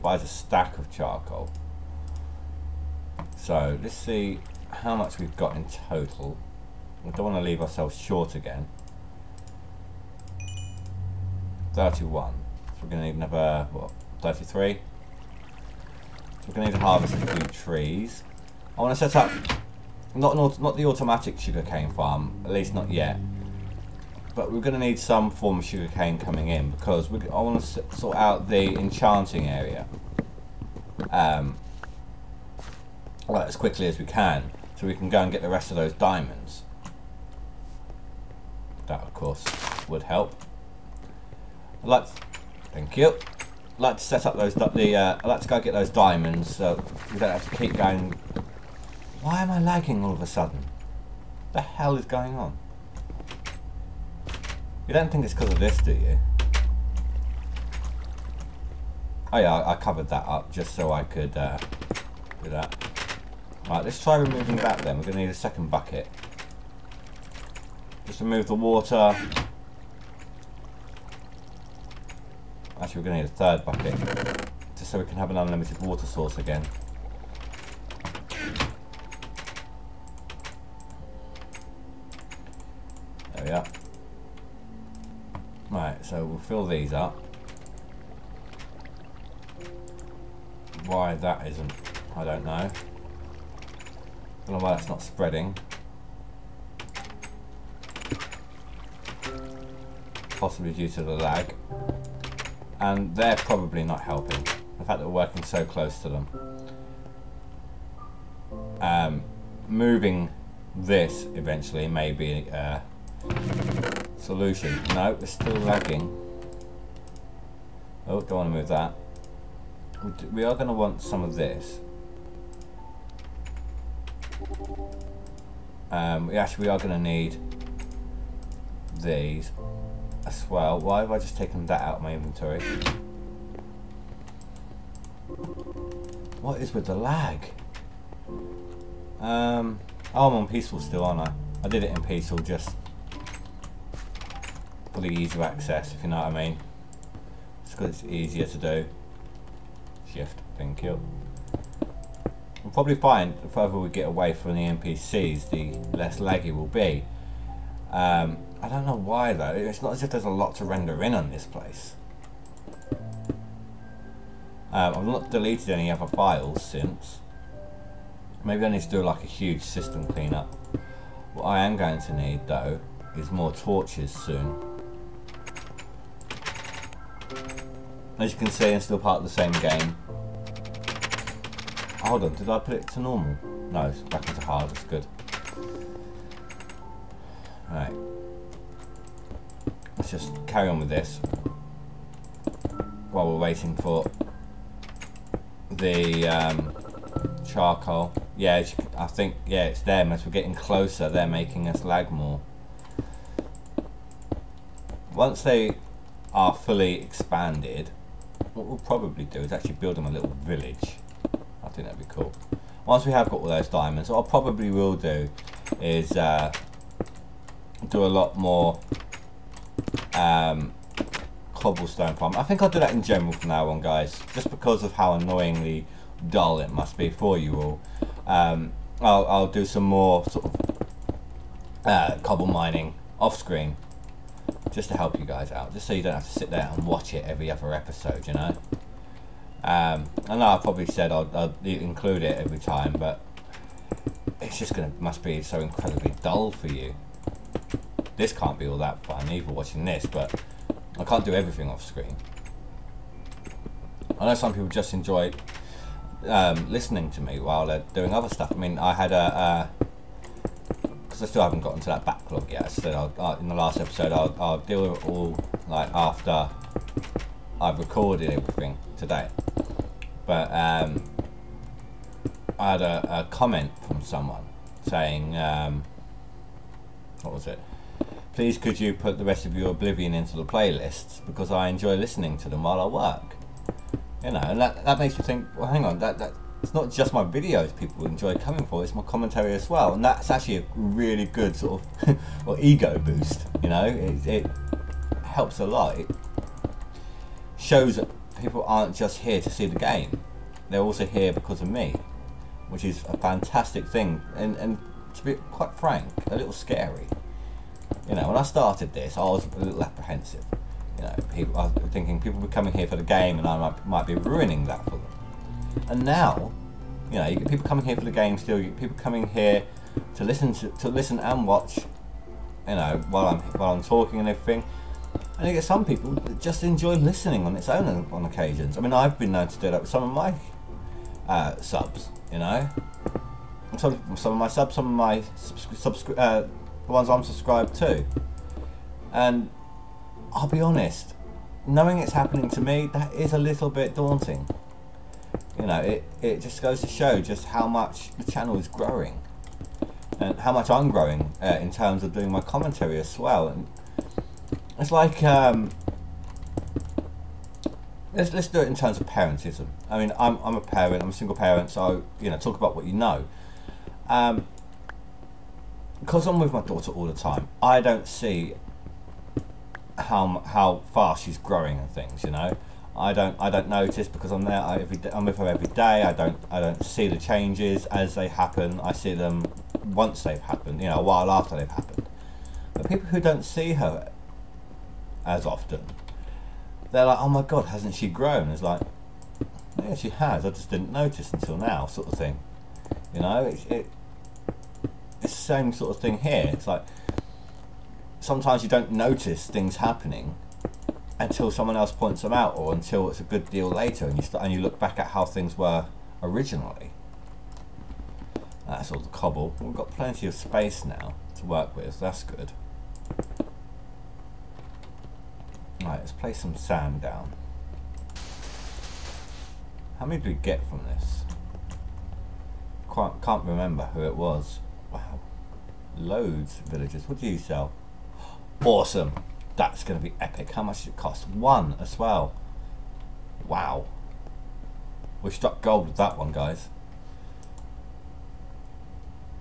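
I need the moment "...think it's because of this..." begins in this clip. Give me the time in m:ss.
0:55.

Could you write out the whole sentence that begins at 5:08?
You know, when I started this, I was a little apprehensive.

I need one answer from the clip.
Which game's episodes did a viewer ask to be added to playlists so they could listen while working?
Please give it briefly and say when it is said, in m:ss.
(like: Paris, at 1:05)
Oblivion, at 4:39.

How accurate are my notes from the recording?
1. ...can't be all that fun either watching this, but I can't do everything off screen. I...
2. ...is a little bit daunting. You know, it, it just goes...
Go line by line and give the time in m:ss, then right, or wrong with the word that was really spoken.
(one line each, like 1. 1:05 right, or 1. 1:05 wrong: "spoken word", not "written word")
1. 4:08 right
2. 5:43 right.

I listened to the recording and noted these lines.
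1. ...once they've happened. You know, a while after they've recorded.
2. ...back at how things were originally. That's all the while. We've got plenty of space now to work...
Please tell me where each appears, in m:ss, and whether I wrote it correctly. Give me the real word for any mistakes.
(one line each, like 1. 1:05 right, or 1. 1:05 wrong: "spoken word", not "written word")
1. 6:19 wrong: "happened", not "recorded"
2. 6:44 wrong: "cobble", not "while".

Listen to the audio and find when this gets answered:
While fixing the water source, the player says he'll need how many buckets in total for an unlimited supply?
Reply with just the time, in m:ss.
1:13.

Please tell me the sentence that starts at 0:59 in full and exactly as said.
Oh yeah, I covered that up just so I could uh, do that.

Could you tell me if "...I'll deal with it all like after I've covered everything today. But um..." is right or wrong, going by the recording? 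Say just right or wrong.
wrong.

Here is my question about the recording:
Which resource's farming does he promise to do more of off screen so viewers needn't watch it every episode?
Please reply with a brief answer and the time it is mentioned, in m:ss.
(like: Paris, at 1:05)
Cobblestone, at 3:41.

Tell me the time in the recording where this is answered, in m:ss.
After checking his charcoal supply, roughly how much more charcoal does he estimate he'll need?
0:14.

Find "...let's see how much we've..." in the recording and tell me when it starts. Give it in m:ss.
0:03.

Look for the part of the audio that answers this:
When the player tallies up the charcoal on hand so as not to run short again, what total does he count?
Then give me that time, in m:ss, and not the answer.
0:11.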